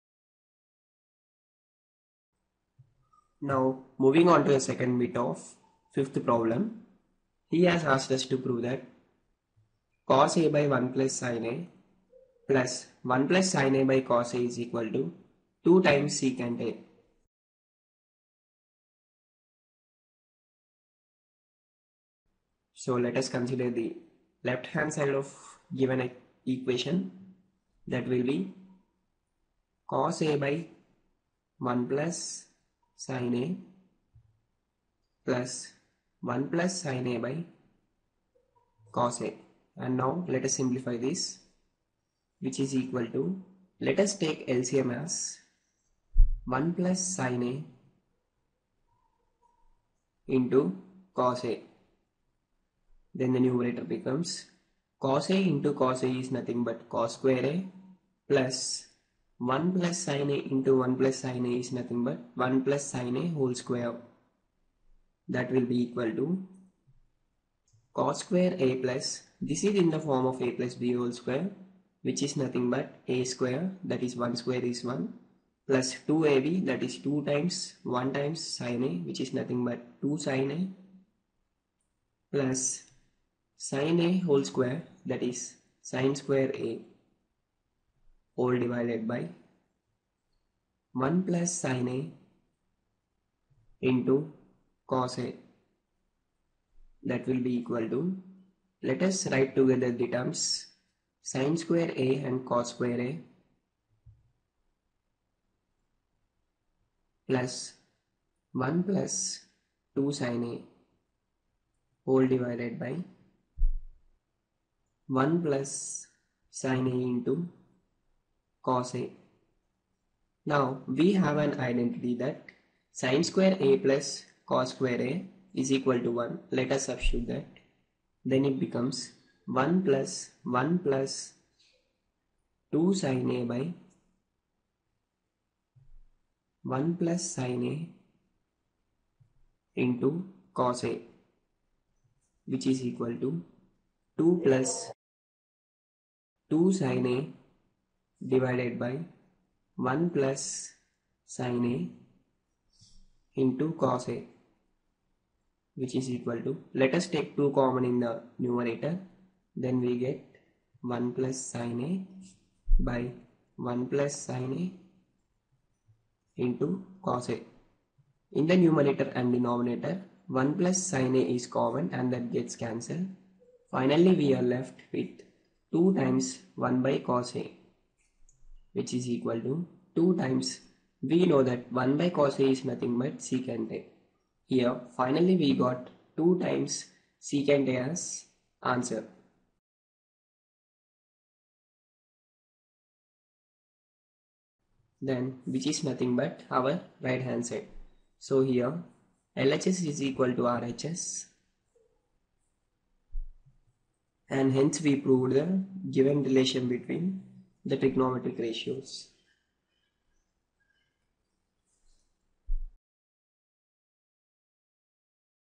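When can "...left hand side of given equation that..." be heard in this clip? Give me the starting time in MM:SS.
00:24.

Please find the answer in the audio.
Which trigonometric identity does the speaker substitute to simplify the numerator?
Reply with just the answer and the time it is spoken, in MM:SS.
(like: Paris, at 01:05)
sin²A + cos²A = 1, at 02:03.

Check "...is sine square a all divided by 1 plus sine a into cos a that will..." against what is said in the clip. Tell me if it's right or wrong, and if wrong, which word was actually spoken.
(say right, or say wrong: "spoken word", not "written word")
right.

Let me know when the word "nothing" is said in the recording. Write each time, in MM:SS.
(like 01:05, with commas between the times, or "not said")
00:56, 01:01, 01:12, 01:19, 03:02, 03:15.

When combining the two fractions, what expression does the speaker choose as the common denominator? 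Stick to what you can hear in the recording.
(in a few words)
1 plus sin a into cos a.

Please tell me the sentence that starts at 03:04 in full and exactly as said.
Here finally we got 2 times secant A as answer.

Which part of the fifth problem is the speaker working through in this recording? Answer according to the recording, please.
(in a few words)
Second bit.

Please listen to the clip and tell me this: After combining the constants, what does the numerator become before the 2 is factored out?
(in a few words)
2 plus 2 sin A.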